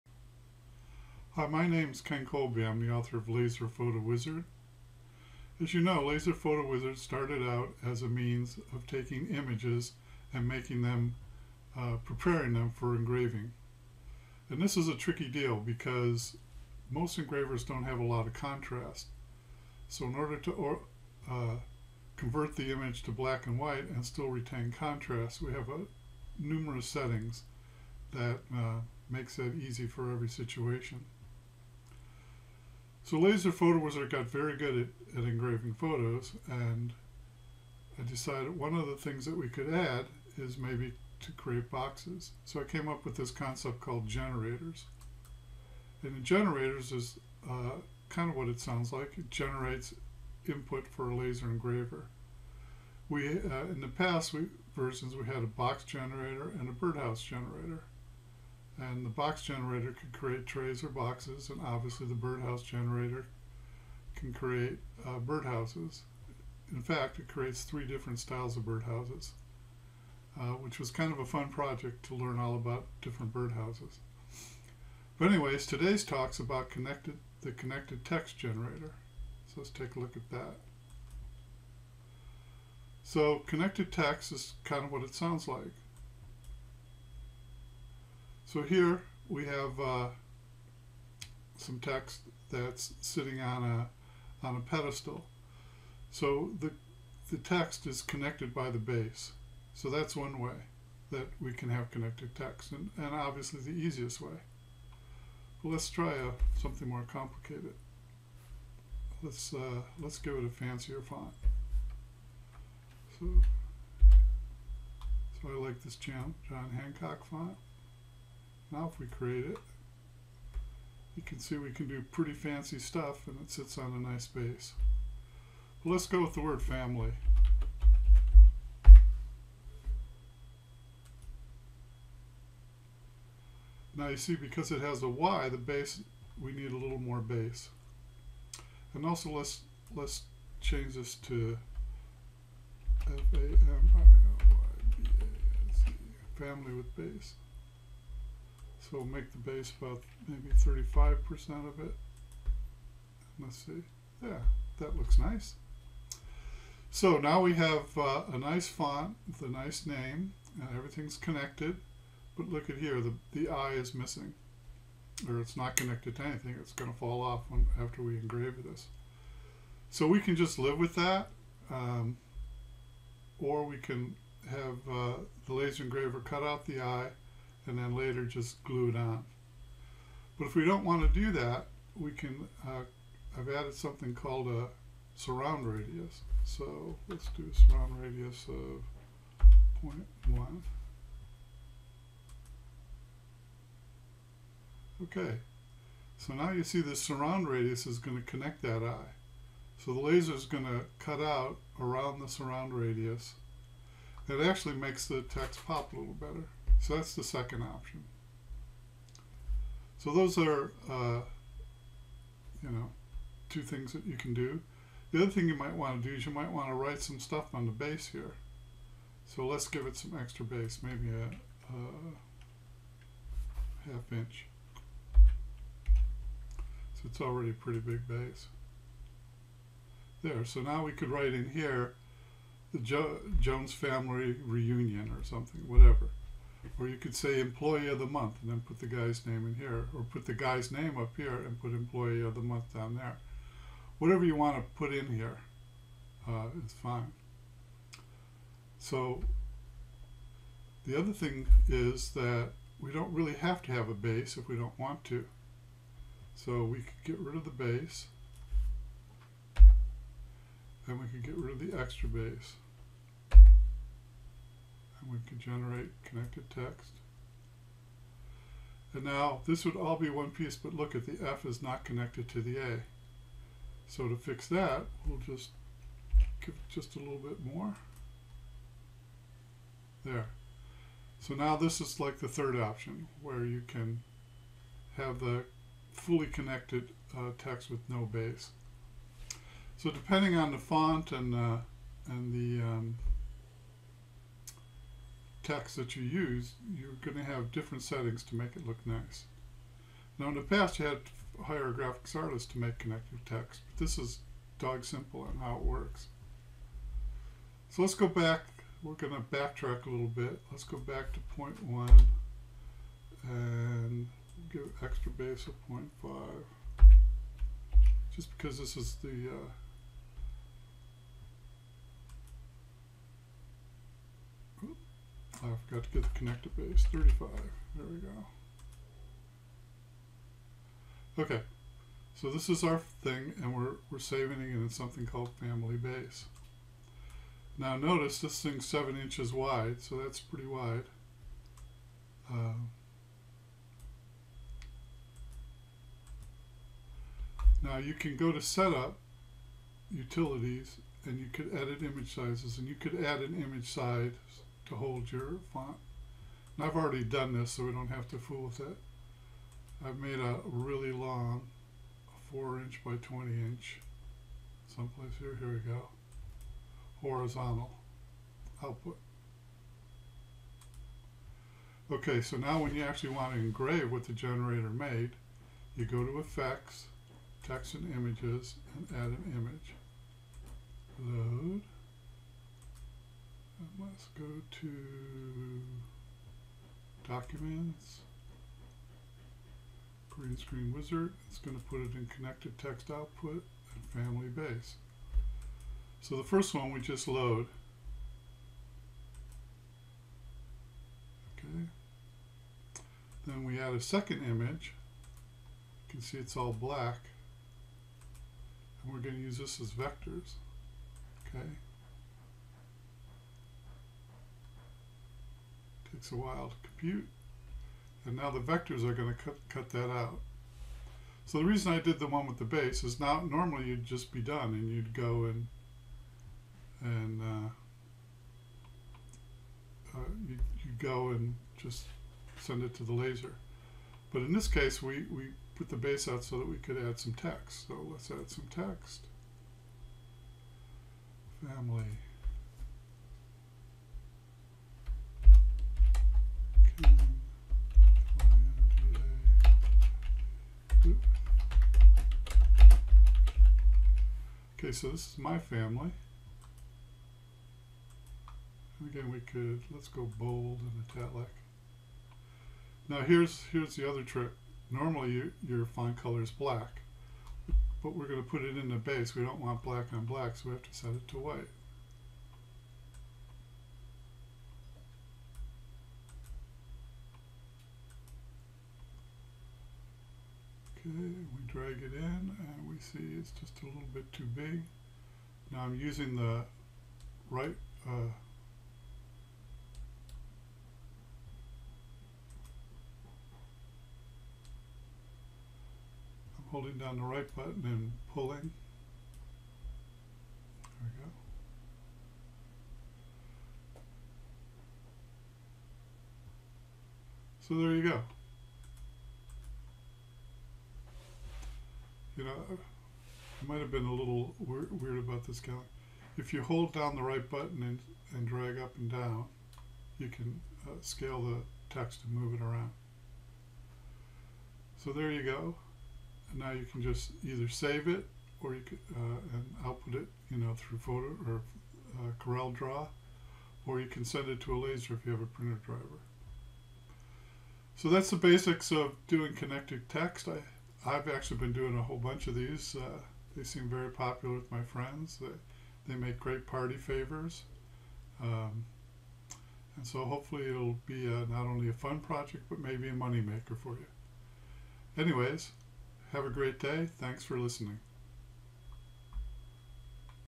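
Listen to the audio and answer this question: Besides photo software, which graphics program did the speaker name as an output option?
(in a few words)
Corel Draw.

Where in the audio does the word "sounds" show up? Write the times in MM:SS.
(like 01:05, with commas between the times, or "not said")
00:48, 01:25.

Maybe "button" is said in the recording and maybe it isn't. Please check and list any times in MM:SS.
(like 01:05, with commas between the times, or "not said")
08:17, 08:37.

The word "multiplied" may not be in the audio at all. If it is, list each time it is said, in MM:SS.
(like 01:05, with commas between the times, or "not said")
not said.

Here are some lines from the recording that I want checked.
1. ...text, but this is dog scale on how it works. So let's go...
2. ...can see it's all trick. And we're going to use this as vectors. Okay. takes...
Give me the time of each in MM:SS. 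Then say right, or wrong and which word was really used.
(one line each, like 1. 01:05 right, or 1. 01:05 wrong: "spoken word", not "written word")
1. 05:03 wrong: "simple", not "scale"
2. 06:45 wrong: "black", not "trick".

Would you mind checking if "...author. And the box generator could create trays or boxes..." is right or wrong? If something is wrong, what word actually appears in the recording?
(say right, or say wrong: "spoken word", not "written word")
wrong: "generator", not "author".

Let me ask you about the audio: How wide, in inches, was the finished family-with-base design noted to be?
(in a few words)
7 inches.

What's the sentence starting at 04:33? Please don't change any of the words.
So to fix that, we'll just give it just a little bit more.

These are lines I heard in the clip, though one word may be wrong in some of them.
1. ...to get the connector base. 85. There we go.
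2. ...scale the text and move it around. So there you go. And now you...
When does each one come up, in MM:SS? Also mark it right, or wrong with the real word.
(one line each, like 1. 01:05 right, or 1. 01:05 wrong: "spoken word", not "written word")
1. 05:25 wrong: "35", not "85"
2. 08:40 right.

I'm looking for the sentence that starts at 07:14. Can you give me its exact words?
But in this case, we, we put the base out so that we could add some text.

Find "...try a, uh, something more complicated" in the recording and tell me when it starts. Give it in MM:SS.
01:45.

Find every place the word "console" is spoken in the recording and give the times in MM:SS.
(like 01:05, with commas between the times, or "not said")
not said.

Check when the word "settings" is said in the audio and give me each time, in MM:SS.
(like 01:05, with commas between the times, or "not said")
00:26, 04:57.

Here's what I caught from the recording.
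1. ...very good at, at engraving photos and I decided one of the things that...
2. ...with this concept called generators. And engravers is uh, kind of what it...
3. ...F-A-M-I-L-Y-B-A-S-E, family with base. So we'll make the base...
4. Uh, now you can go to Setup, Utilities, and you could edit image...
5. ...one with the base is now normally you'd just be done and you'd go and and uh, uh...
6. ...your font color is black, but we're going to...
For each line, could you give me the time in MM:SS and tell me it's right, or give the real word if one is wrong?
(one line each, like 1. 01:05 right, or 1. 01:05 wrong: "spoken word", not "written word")
1. 00:34 right
2. 00:43 wrong: "generators", not "engravers"
3. 02:23 right
4. 05:42 right
5. 07:02 right
6. 07:45 right.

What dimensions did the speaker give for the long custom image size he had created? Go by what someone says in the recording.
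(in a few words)
4 inch by 20 inch.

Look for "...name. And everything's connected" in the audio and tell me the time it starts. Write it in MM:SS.
02:39.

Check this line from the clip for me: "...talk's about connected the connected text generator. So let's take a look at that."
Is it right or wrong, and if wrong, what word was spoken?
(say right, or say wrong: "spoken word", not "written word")
right.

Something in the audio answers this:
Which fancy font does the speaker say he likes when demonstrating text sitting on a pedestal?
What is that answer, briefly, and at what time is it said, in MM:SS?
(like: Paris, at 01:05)
John Hancock, at 01:56.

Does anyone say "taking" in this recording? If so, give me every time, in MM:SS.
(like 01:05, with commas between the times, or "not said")
00:08.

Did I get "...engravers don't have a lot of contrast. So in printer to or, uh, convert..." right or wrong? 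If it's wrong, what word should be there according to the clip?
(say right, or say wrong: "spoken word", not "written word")
wrong: "order", not "printer".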